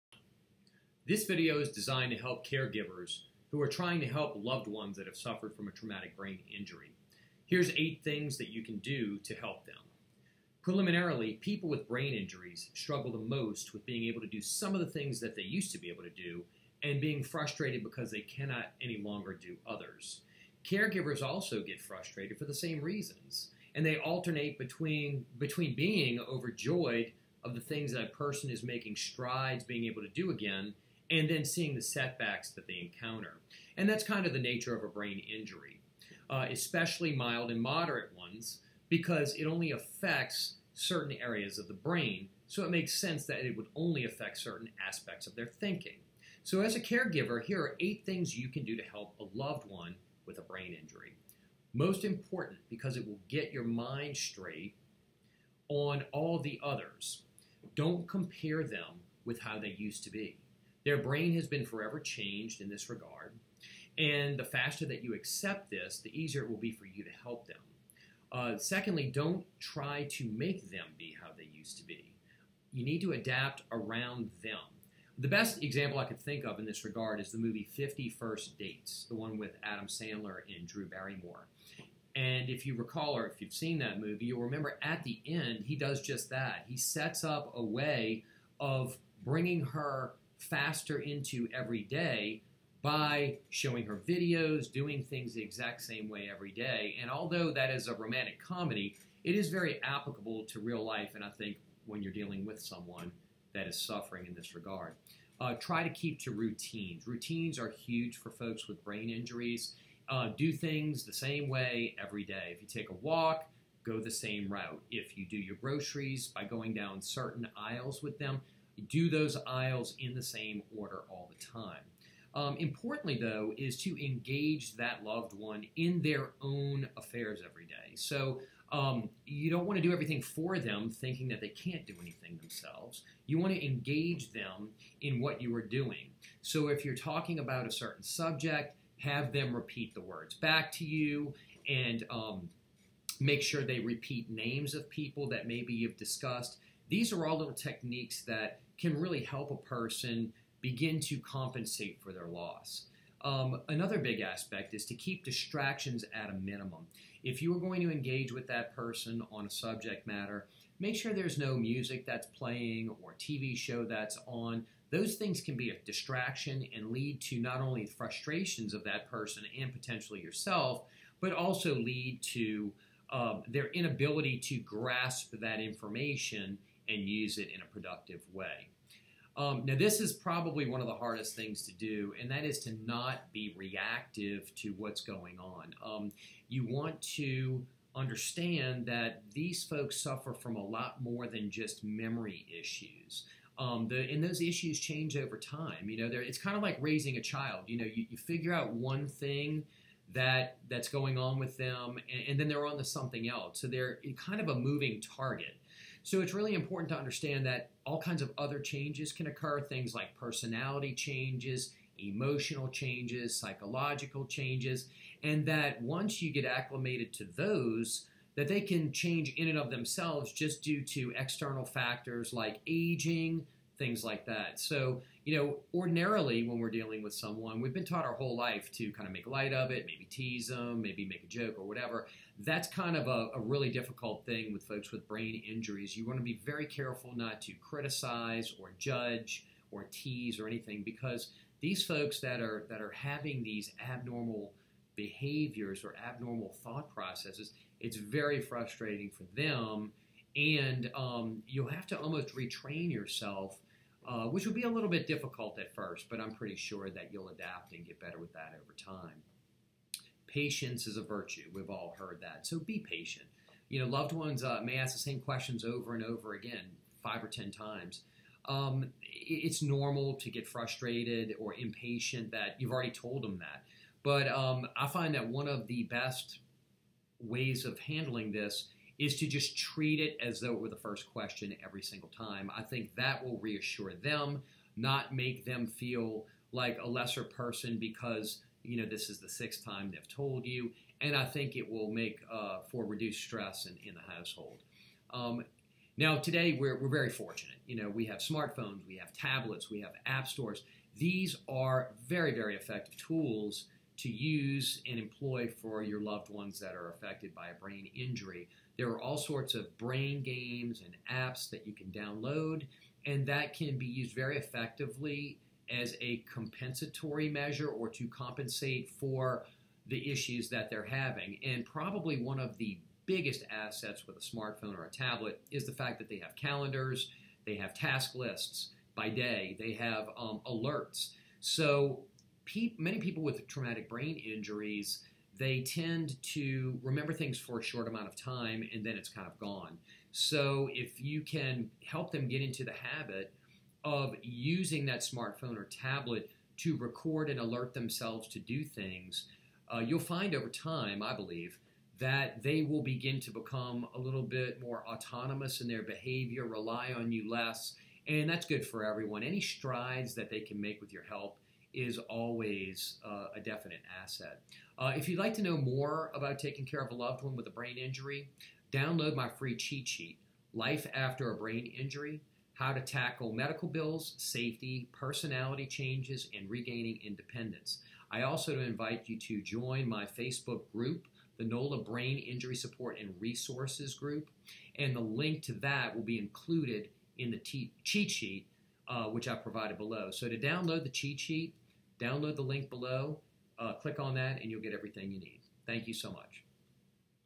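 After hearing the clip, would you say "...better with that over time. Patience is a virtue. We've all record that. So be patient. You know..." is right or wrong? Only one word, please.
wrong.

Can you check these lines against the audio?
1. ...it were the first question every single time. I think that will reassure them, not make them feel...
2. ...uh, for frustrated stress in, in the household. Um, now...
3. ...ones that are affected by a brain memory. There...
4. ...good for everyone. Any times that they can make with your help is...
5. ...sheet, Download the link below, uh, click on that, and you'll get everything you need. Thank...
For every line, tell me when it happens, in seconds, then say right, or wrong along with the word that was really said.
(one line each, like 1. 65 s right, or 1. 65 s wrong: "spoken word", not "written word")
1. 280 s right
2. 292 s wrong: "reduced", not "frustrated"
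3. 306 s wrong: "injury", not "memory"
4. 358 s wrong: "strides", not "times"
5. 391 s right.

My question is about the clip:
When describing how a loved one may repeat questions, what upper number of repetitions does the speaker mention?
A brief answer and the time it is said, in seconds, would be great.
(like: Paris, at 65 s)
10, at 267 s.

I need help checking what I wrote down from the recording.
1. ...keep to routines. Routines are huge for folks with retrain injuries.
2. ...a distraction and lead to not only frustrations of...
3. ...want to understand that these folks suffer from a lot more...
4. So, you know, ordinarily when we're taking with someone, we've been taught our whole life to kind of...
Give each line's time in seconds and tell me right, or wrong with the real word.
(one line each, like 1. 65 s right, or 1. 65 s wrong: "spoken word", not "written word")
1. 105 s wrong: "brain", not "retrain"
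2. 165 s right
3. 186 s right
4. 224 s wrong: "dealing", not "taking".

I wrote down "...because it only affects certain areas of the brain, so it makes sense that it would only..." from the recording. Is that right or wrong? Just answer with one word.
right.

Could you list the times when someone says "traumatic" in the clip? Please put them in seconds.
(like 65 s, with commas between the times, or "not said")
5 s, 333 s.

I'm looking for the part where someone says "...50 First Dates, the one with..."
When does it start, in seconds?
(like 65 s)
77 s.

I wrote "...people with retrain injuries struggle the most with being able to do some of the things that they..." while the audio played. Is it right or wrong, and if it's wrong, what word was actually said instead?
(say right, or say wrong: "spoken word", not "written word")
wrong: "brain", not "retrain".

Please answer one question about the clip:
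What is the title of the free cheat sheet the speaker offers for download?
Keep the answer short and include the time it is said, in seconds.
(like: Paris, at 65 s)
Life After a Brain Injury, at 370 s.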